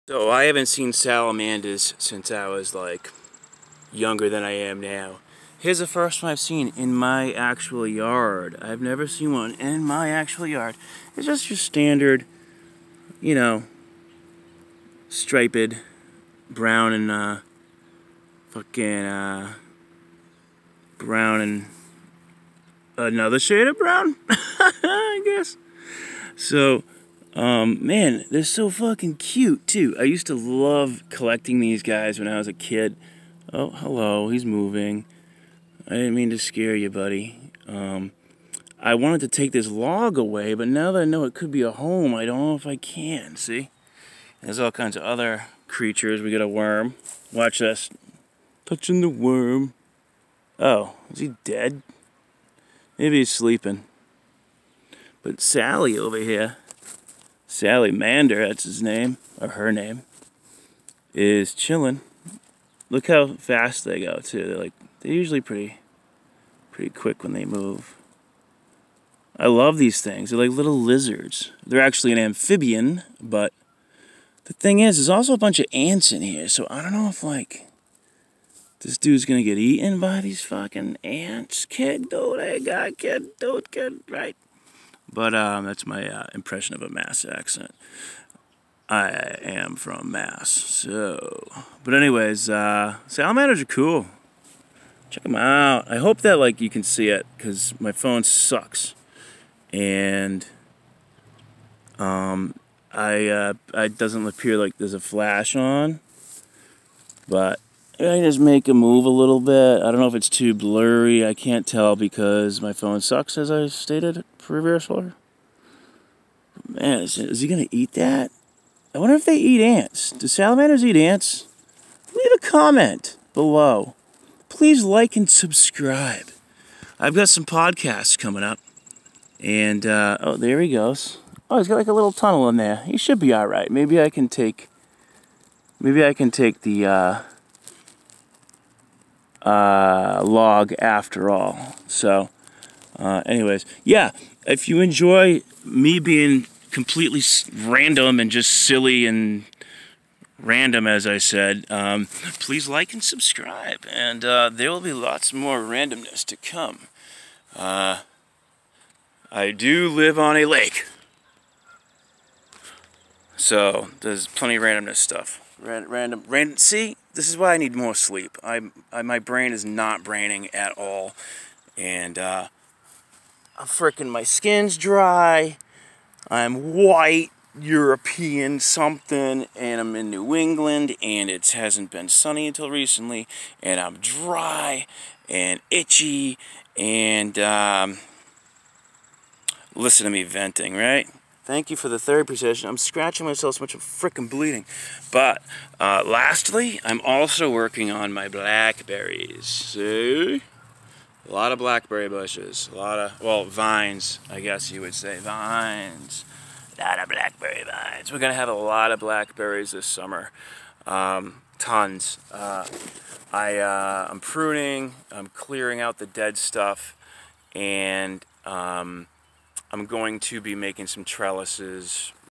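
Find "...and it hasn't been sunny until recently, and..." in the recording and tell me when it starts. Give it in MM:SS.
03:01.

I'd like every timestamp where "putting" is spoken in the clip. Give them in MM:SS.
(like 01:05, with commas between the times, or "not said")
not said.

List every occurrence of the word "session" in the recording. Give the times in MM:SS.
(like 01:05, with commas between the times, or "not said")
03:12.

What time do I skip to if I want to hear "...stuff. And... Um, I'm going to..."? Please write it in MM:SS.
03:36.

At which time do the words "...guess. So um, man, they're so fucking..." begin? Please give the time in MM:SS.
00:25.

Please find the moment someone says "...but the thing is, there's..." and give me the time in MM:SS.
01:13.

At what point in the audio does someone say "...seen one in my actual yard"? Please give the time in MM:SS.
00:09.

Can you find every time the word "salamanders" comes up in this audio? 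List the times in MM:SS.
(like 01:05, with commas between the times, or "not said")
00:00, 00:57, 01:33, 02:00.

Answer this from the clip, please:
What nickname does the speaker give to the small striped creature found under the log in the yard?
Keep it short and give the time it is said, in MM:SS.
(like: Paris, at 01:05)
Sally, at 00:55.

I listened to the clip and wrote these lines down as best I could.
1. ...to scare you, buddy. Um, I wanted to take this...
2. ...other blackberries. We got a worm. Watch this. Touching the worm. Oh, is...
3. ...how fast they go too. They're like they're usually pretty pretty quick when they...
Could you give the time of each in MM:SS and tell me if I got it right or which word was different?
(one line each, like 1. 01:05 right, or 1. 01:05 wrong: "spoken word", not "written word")
1. 00:36 right
2. 00:45 wrong: "creatures", not "blackberries"
3. 01:03 right.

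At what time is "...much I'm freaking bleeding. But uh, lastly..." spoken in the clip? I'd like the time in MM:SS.
03:13.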